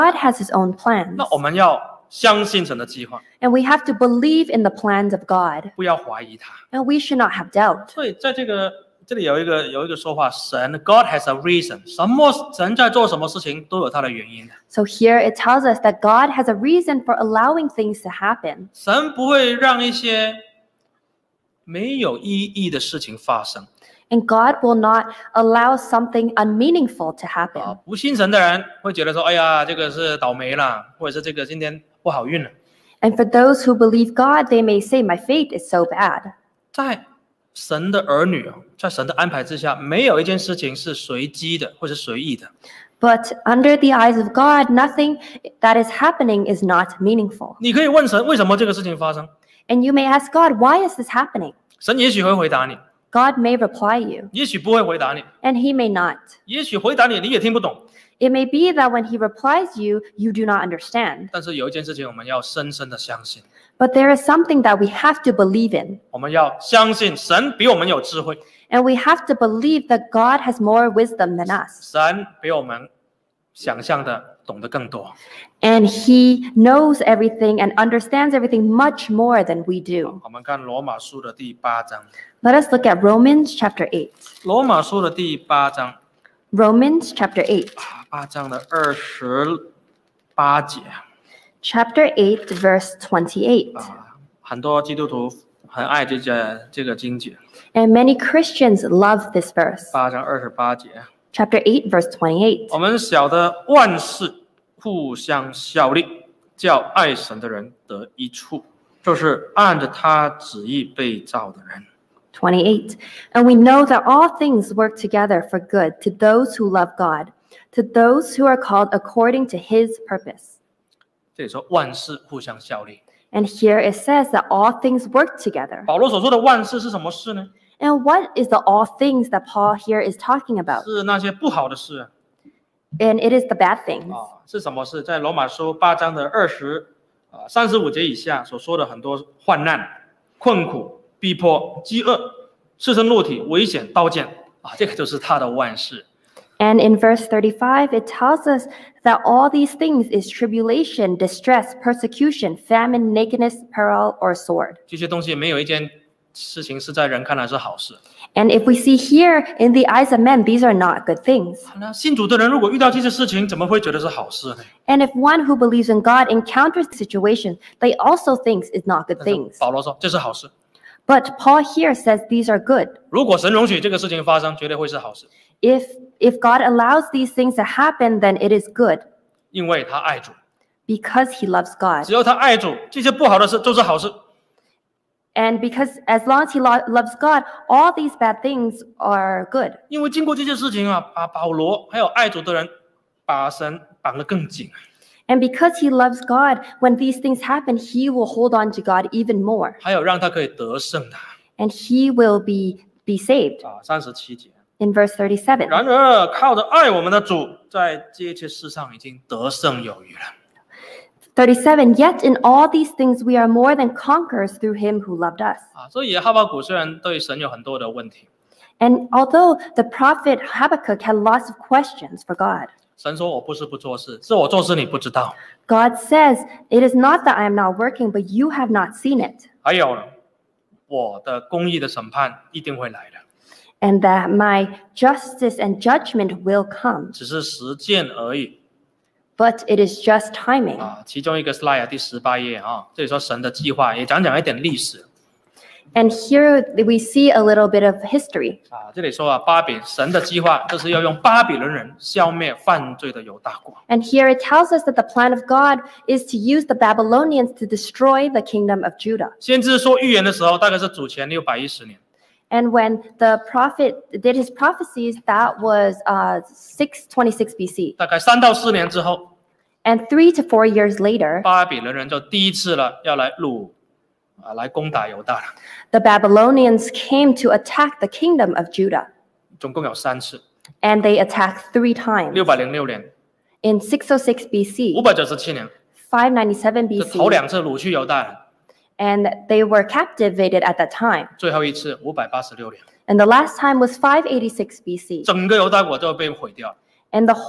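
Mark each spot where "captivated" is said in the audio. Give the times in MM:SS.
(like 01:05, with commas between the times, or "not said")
04:49.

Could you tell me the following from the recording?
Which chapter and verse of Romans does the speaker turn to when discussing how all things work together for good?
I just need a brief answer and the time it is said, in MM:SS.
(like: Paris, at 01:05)
Chapter 8, verse 28, at 01:31.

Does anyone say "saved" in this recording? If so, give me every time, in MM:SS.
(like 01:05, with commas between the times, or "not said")
03:23.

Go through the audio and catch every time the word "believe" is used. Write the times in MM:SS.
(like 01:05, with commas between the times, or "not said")
00:03, 00:33, 01:05, 01:09, 02:45.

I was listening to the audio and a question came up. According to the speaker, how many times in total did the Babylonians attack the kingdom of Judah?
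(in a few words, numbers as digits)
3.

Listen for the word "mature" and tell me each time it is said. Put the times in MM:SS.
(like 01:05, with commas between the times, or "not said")
not said.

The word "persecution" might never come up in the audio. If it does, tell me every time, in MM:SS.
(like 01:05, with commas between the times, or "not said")
02:31.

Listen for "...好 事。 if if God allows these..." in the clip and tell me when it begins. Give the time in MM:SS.
02:54.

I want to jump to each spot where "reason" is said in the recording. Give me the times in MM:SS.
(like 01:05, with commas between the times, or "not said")
00:11, 00:16.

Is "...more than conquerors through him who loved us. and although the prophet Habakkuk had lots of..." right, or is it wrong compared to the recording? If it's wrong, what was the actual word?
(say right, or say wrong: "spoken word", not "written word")
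right.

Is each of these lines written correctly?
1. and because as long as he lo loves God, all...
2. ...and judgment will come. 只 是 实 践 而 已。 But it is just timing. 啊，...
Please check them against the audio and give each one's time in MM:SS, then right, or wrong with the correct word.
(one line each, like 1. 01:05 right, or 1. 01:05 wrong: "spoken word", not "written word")
1. 03:05 right
2. 03:55 right.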